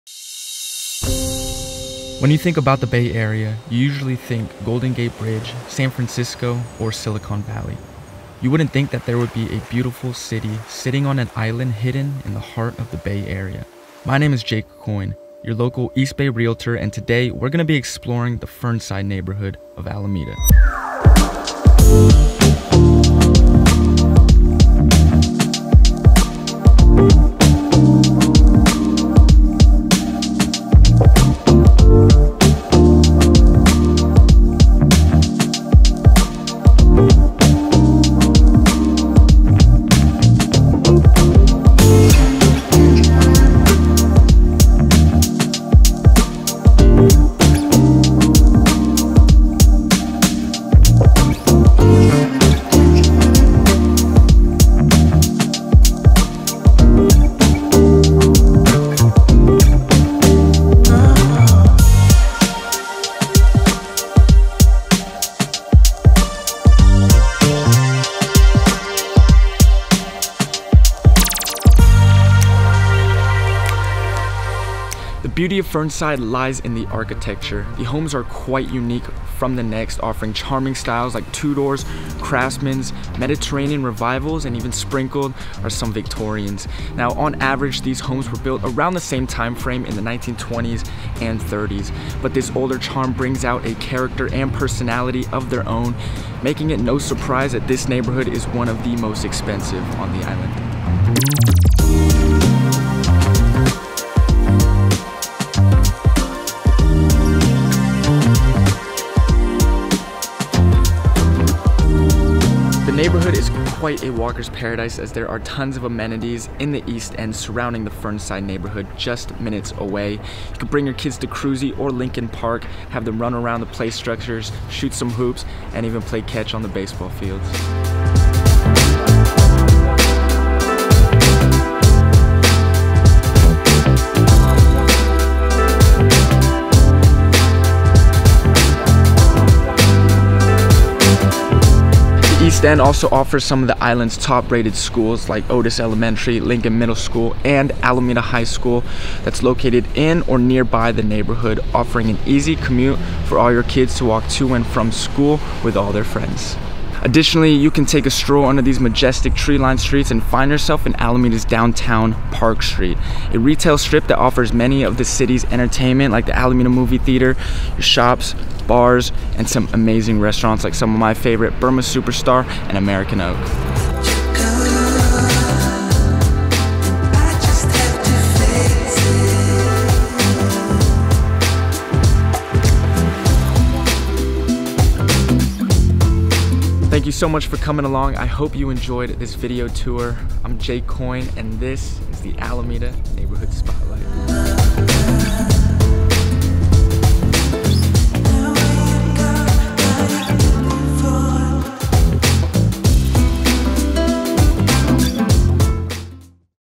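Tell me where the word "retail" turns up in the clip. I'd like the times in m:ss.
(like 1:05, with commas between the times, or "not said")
2:43.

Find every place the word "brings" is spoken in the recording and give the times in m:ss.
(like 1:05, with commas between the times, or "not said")
1:33, 2:00.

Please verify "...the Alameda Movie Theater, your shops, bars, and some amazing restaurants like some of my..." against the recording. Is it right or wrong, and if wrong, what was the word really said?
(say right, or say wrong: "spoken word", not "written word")
right.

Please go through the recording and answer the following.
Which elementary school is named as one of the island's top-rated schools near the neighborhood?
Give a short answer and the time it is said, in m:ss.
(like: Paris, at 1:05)
Otis Elementary, at 2:25.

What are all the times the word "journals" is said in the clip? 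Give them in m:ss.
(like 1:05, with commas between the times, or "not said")
not said.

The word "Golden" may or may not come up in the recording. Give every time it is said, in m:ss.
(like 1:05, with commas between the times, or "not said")
0:04.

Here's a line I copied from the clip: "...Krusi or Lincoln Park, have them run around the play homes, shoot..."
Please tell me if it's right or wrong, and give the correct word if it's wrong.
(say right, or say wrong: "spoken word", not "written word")
wrong: "structures", not "homes".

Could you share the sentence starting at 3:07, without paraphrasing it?
Thank you so much for coming along.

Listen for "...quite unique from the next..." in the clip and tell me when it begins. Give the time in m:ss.
1:18.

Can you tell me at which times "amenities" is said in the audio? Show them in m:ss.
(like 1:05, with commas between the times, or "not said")
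1:55.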